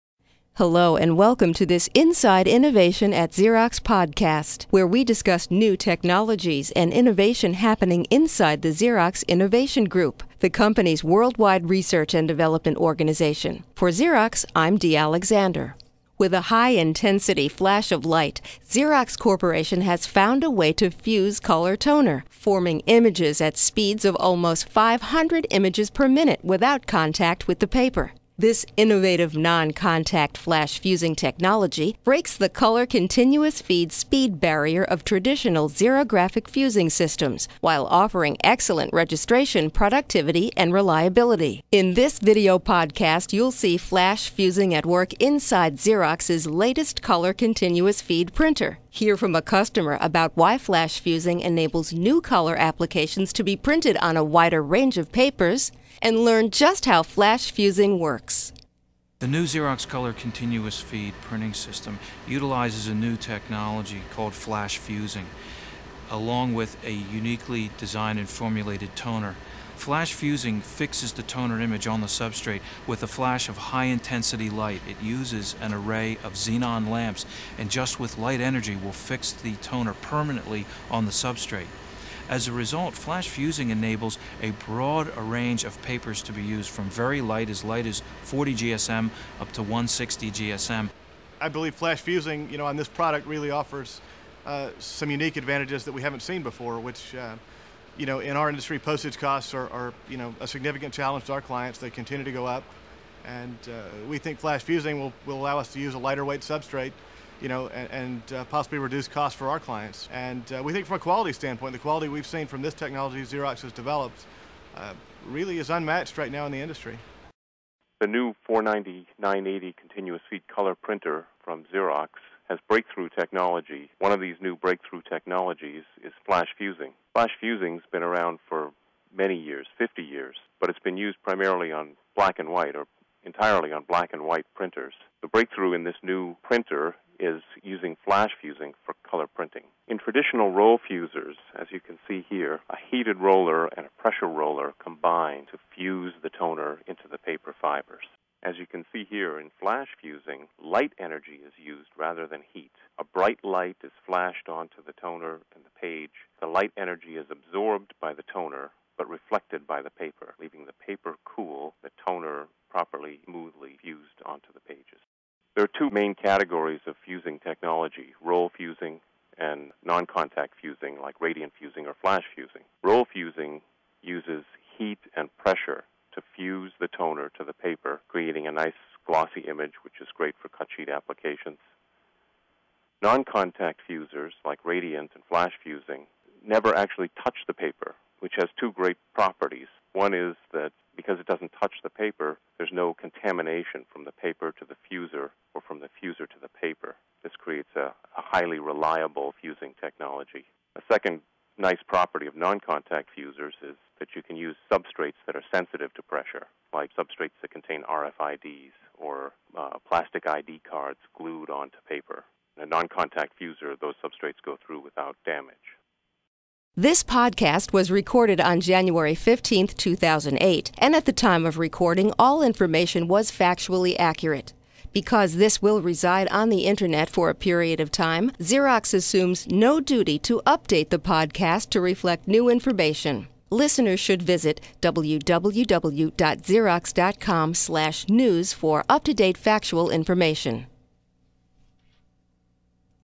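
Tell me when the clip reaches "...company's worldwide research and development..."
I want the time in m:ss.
0:10.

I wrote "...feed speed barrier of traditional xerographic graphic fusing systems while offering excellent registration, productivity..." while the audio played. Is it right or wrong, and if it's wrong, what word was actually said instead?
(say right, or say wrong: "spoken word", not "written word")
right.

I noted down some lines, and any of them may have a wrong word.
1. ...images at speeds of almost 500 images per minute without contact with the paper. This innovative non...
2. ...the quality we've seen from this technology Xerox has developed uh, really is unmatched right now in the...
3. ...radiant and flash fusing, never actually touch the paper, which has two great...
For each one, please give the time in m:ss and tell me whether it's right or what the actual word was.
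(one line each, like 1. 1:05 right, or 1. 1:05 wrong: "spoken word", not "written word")
1. 0:22 right
2. 1:51 right
3. 3:04 right.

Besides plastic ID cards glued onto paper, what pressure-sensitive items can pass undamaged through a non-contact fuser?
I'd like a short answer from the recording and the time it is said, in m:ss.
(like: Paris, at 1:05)
RFIDs, at 3:27.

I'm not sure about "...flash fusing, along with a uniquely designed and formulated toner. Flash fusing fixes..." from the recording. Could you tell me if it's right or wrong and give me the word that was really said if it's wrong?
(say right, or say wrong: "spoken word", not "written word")
right.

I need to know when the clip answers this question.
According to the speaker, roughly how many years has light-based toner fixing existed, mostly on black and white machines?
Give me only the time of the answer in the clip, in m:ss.
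2:09.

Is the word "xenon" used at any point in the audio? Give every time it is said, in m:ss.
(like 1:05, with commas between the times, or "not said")
1:16.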